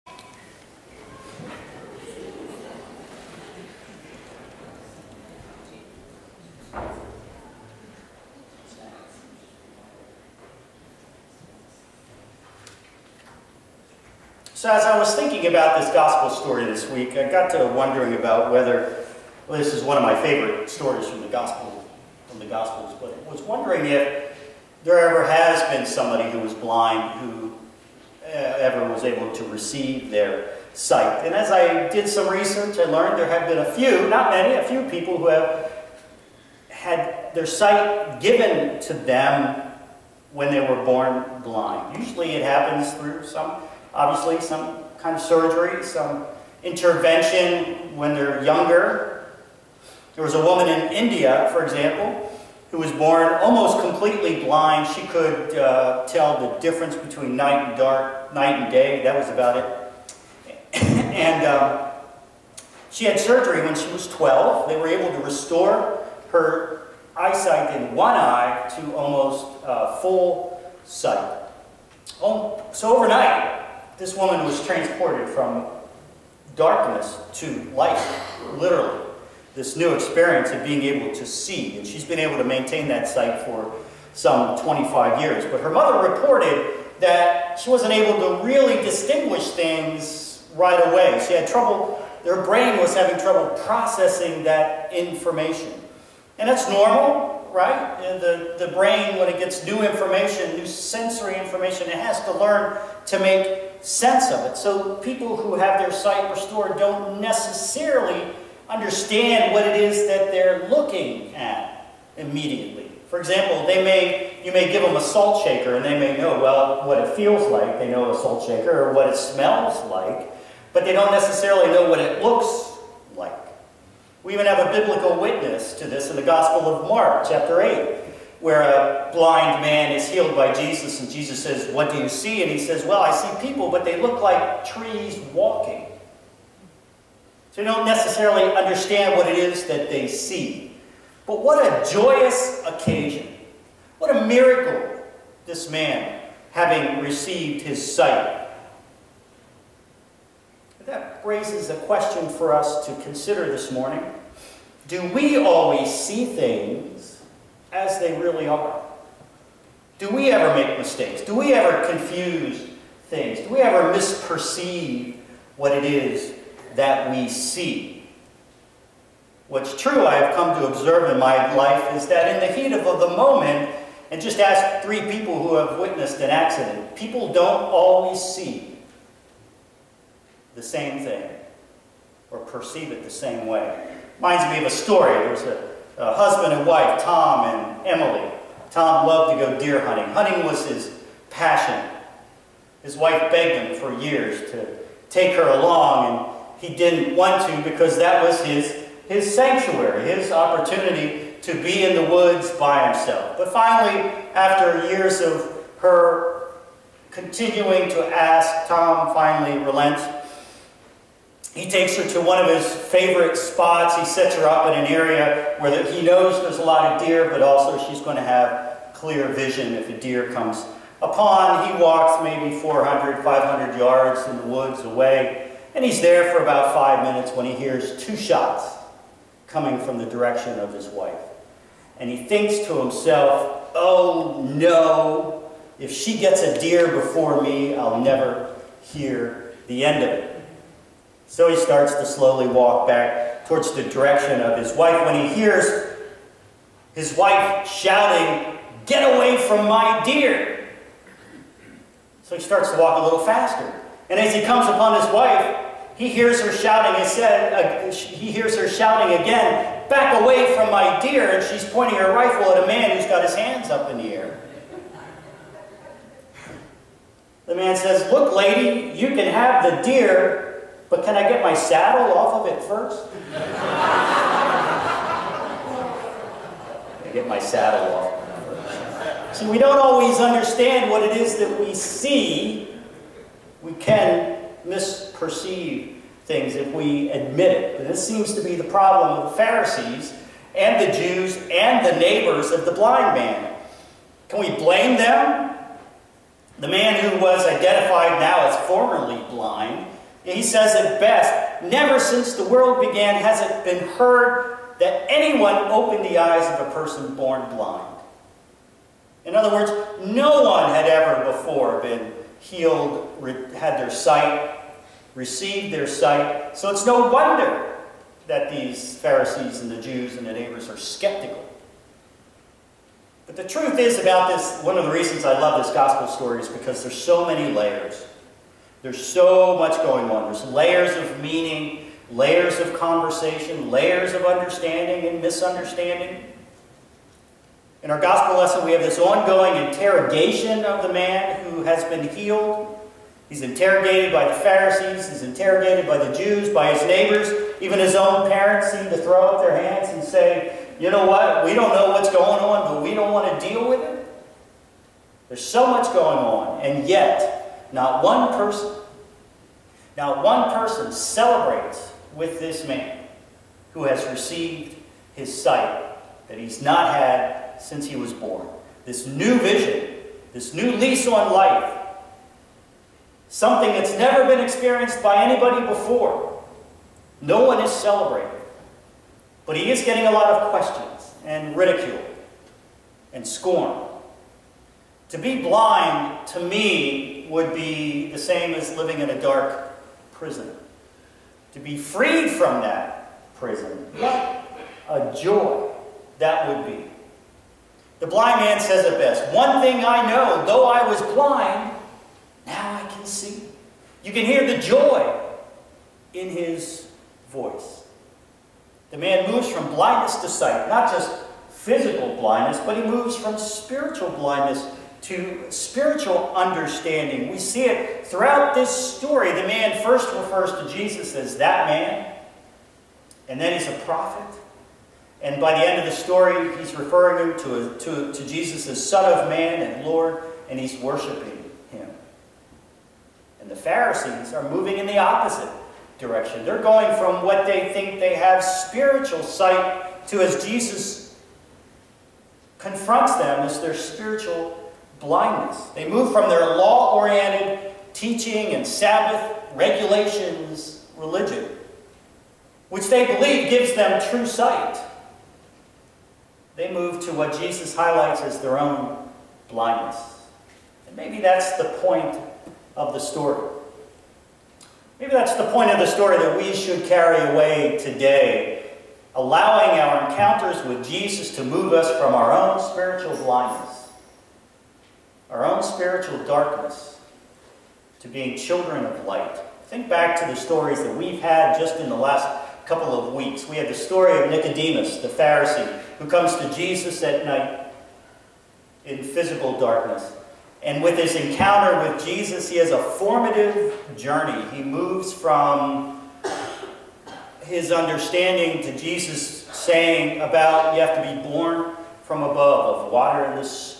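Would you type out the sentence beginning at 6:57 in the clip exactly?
We see it throughout this story.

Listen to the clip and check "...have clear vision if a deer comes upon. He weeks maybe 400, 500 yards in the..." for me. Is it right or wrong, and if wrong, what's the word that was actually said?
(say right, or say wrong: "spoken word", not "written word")
wrong: "walks", not "weeks".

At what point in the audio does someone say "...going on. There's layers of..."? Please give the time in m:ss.
5:29.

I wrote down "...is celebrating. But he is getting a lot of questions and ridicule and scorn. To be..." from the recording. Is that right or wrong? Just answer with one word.
right.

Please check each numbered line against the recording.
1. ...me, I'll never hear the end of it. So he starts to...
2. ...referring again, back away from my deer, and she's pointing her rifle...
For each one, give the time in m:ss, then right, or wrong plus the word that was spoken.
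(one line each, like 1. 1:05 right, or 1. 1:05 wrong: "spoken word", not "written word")
1. 3:57 right
2. 4:18 wrong: "shouting", not "referring".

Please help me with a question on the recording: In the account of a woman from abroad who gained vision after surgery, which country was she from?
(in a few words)
India.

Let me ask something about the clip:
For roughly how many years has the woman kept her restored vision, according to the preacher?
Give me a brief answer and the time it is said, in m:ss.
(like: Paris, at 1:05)
25, at 1:24.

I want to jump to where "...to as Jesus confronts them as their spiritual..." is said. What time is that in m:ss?
7:20.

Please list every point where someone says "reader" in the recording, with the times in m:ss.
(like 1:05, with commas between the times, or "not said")
not said.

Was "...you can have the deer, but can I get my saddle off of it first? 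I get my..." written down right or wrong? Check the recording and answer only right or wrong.
right.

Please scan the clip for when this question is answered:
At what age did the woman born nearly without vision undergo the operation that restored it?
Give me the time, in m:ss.
1:04.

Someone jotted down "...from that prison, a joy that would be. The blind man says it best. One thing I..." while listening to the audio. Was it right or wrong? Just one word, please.
right.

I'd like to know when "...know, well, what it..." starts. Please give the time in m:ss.
1:56.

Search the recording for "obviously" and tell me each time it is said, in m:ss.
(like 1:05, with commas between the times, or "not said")
0:43.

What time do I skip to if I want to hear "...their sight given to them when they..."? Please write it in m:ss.
0:37.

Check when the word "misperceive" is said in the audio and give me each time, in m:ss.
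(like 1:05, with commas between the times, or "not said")
2:43, 4:44.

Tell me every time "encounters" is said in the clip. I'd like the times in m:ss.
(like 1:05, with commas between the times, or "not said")
7:50, 8:11.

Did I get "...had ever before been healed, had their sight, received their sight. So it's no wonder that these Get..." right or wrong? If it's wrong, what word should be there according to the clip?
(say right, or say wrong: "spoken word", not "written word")
wrong: "Pharisees", not "Get".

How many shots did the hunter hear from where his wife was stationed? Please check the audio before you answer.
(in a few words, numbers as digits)
2.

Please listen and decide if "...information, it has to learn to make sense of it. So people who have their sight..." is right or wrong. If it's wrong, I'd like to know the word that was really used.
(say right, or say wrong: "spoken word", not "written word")
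right.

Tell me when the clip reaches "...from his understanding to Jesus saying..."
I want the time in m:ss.
8:15.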